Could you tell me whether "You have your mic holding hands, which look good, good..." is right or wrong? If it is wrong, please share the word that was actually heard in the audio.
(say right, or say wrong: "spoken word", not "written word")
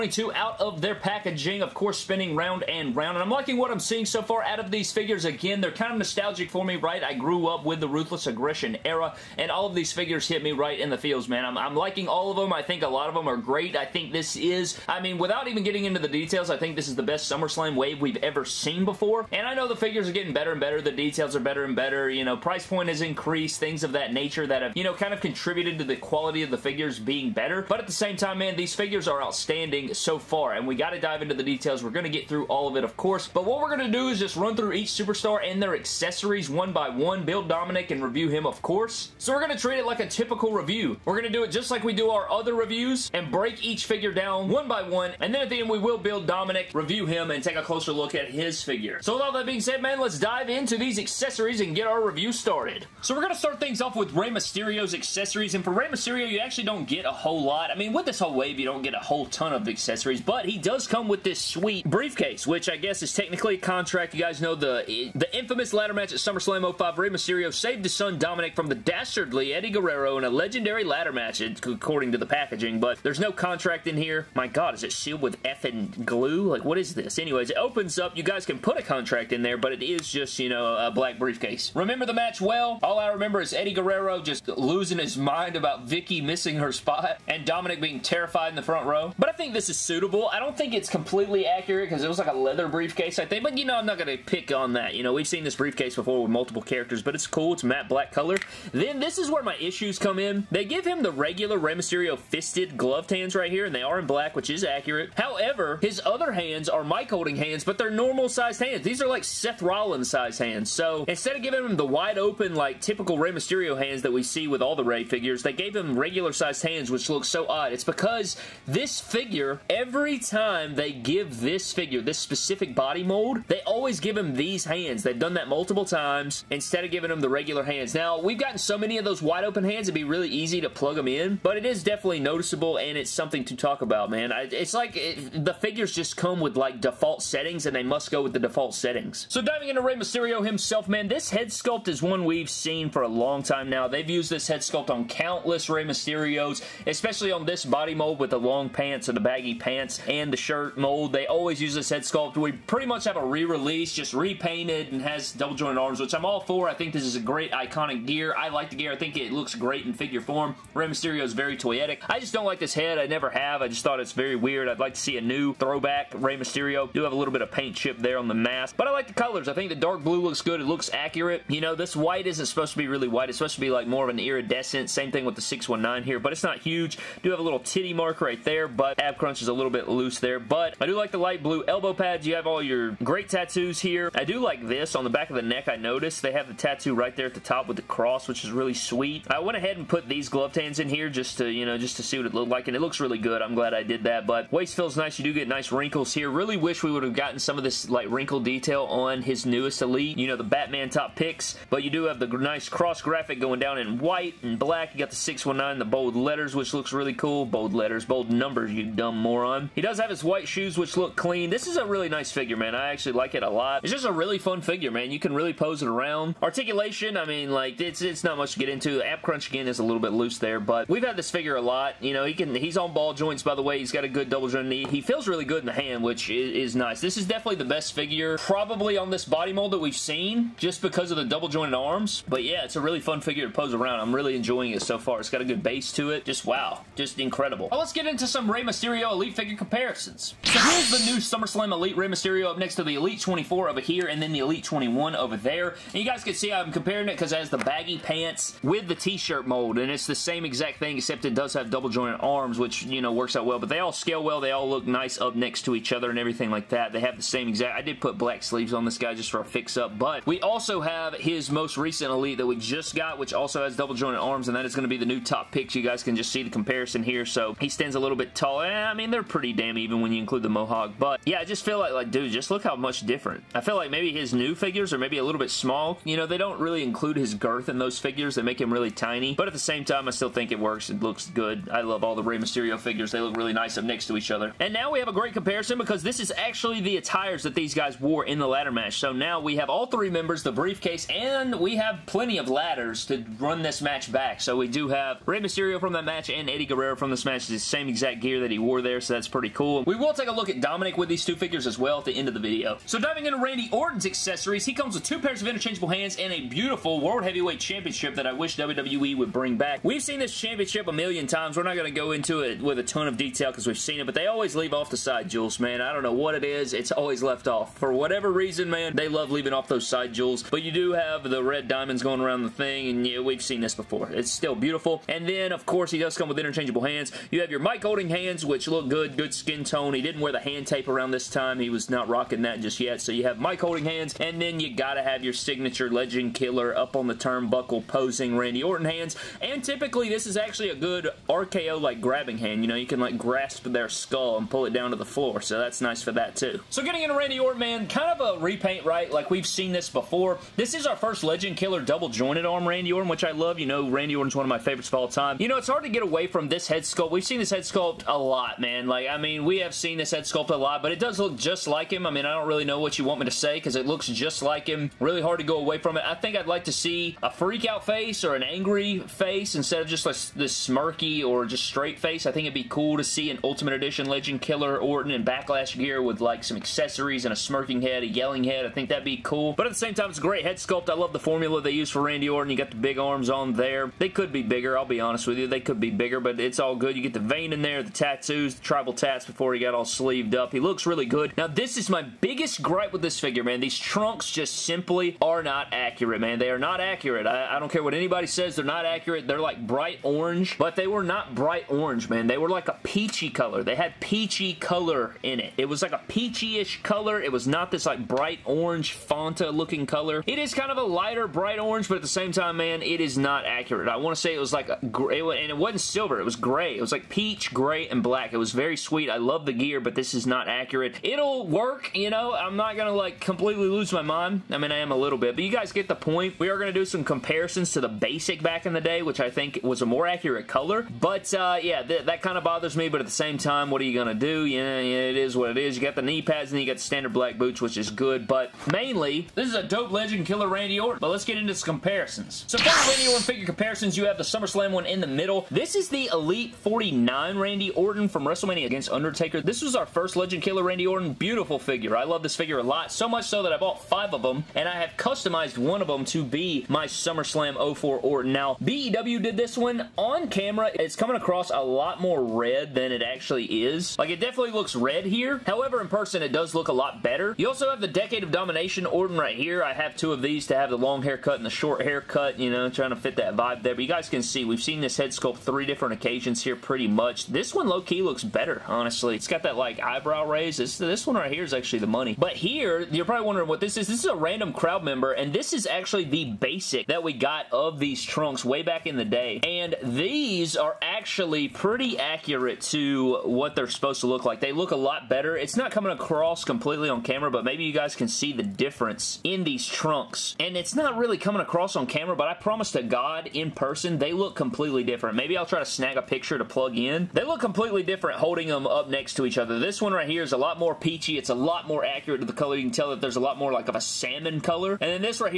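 right.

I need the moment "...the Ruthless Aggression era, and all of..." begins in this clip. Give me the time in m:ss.
0:07.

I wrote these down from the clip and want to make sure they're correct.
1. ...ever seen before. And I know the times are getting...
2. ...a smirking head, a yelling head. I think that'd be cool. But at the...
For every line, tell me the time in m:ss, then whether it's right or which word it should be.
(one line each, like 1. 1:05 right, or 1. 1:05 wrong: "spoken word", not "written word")
1. 0:18 wrong: "figures", not "times"
2. 6:17 right.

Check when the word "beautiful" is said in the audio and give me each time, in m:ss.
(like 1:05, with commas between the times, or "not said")
5:06, 5:24, 7:31.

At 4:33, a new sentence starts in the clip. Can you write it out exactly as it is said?
I feel like maybe his new figures are maybe a little bit small.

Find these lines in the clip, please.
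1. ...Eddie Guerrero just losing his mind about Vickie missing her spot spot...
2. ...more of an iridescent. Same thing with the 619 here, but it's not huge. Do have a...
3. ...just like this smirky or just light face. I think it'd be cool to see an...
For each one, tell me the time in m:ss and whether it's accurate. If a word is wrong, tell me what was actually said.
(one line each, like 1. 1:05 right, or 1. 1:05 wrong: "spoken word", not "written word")
1. 1:23 right
2. 2:53 right
3. 6:09 wrong: "straight", not "light".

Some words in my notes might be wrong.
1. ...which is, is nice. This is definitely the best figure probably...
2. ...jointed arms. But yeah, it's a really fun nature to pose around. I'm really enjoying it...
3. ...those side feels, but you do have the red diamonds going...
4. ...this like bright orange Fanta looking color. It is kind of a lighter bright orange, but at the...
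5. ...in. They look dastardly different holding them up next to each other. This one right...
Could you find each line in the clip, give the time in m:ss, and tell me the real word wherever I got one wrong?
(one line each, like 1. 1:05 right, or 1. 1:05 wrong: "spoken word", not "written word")
1. 3:46 right
2. 3:51 wrong: "figure", not "nature"
3. 5:19 wrong: "jewels", not "feels"
4. 6:47 right
5. 8:26 wrong: "completely", not "dastardly".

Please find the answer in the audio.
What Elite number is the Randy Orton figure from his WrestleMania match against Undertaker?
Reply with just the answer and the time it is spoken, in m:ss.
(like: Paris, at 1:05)
49, at 7:26.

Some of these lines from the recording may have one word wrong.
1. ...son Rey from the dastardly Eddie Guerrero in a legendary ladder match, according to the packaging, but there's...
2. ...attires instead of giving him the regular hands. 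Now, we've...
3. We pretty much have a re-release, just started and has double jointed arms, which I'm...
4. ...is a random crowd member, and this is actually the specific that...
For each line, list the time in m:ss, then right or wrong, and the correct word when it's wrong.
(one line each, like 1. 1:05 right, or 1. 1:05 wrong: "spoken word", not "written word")
1. 1:07 wrong: "Dominik", not "Rey"
2. 2:05 wrong: "times", not "attires"
3. 2:32 wrong: "repainted", not "started"
4. 8:03 wrong: "basic", not "specific".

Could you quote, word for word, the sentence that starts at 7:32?
So much so that I bought five of them, and I have customized one of them to be my SummerSlam 04 Orton.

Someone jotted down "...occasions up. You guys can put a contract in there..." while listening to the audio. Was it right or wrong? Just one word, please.
wrong.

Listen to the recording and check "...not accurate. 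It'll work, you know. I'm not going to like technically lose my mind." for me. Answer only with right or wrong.
wrong.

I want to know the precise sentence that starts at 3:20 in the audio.
You know, the Batman top picks.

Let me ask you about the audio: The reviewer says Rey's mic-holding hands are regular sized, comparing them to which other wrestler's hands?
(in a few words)
Seth Rollins.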